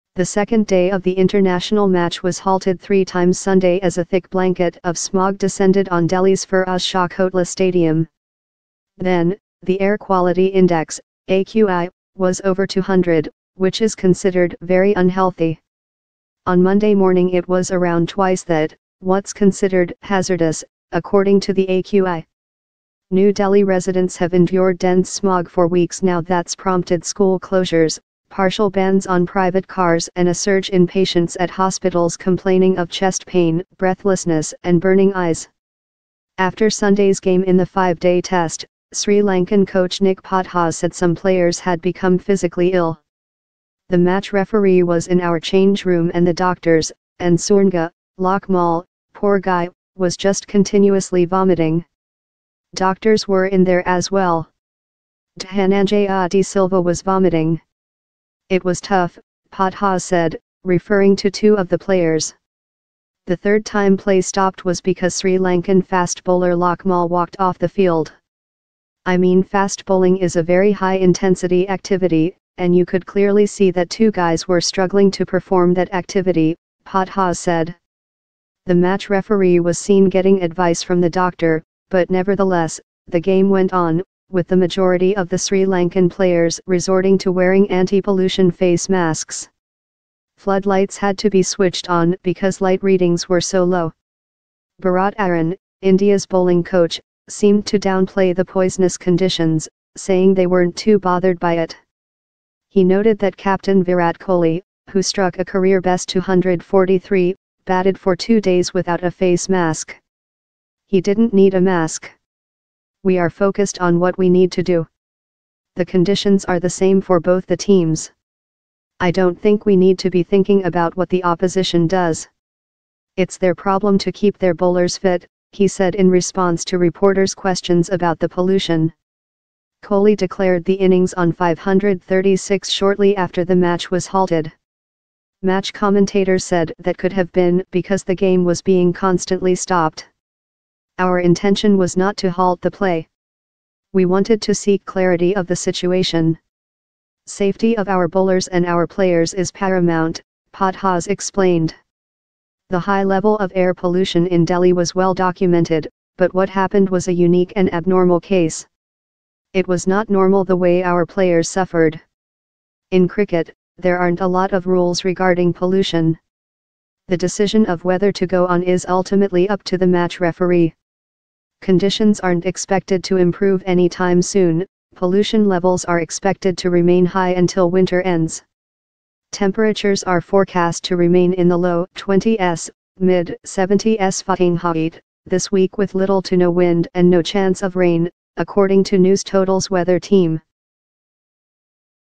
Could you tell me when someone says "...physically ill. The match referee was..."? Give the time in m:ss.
0:42.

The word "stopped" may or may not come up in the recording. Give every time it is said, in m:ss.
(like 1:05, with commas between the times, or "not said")
1:04, 2:19.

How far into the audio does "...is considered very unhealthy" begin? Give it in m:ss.
0:13.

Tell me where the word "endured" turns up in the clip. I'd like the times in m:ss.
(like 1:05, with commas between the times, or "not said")
0:24.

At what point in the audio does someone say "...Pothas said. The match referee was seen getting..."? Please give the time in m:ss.
1:16.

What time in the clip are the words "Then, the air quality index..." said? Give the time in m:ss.
0:08.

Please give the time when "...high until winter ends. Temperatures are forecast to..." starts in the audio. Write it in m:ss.
2:57.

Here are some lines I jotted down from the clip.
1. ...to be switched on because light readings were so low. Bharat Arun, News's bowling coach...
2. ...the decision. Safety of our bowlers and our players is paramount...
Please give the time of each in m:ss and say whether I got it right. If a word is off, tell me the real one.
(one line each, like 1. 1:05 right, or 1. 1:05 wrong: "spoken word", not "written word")
1. 1:31 wrong: "India", not "News"
2. 2:25 wrong: "situation", not "decision".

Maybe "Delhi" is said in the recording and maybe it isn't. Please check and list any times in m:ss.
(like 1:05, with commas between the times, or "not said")
0:06, 0:23, 2:34.